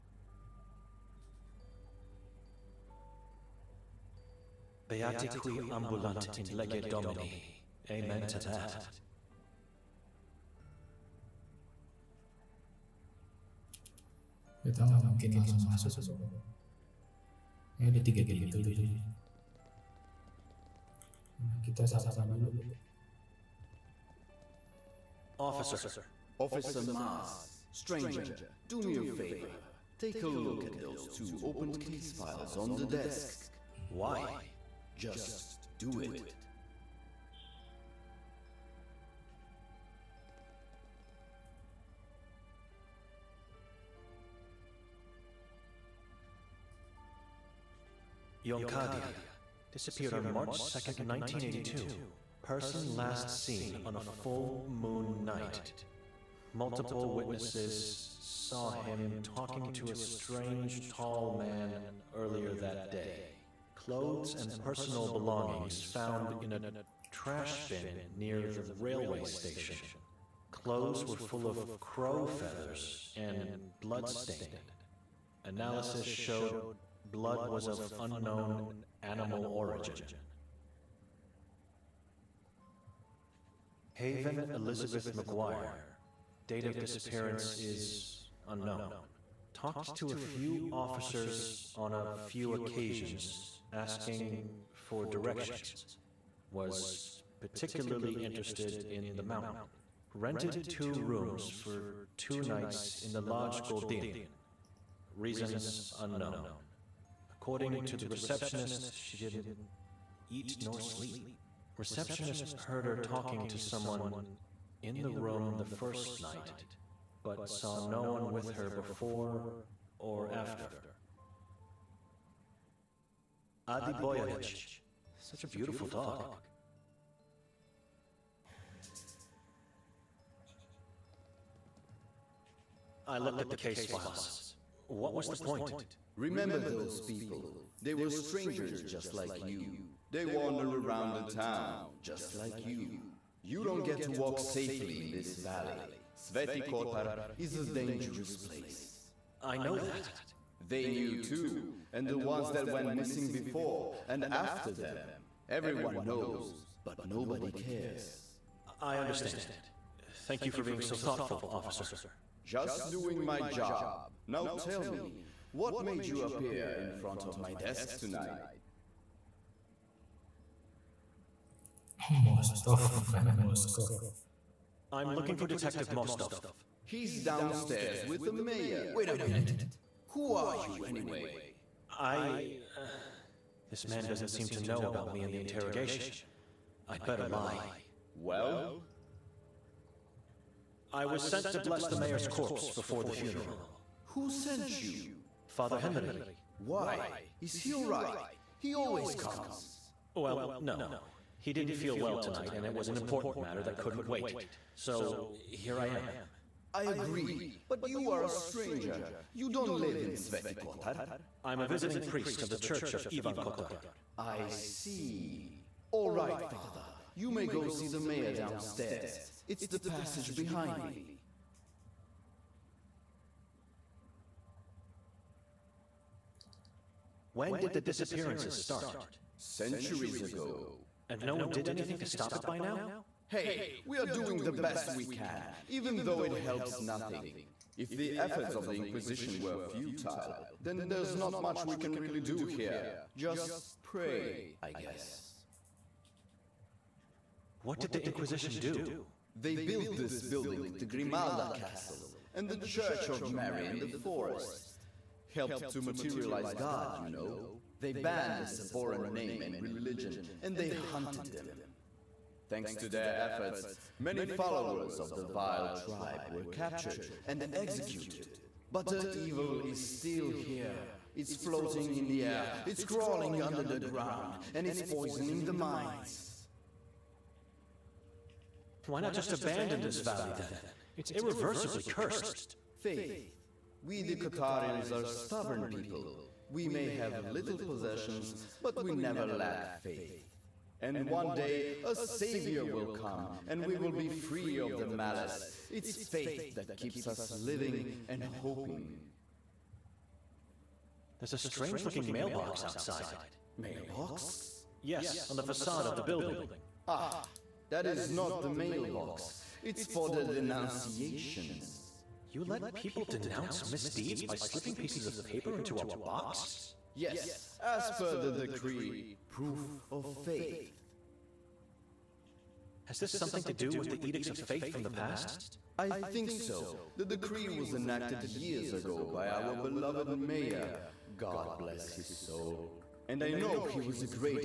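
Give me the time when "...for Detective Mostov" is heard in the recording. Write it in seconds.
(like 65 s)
175 s.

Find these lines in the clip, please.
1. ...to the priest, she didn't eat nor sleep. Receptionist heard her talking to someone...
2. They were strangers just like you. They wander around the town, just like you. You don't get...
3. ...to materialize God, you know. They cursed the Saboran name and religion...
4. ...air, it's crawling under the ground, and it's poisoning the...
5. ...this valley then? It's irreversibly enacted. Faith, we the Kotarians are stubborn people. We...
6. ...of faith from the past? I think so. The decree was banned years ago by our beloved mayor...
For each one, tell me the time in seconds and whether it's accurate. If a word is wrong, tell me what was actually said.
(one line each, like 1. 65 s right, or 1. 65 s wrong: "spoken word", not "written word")
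1. 107 s wrong: "receptionist", not "priest"
2. 137 s right
3. 255 s wrong: "banned", not "cursed"
4. 272 s right
5. 279 s wrong: "cursed", not "enacted"
6. 324 s wrong: "enacted", not "banned".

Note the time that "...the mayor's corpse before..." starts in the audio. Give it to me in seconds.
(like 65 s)
191 s.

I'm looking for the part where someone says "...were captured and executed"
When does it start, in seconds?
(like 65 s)
266 s.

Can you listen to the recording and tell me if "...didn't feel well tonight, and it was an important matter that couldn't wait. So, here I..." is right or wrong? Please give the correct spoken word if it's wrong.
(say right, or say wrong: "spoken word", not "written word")
right.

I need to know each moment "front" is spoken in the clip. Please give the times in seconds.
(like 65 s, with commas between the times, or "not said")
166 s.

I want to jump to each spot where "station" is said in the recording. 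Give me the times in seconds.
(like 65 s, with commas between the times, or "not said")
69 s.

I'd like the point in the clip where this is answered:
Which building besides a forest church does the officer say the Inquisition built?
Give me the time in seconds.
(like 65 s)
250 s.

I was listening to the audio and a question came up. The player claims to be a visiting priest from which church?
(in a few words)
Church of Ivan Kotar.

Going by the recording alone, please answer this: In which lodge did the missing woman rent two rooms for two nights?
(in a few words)
Lodge Goldin.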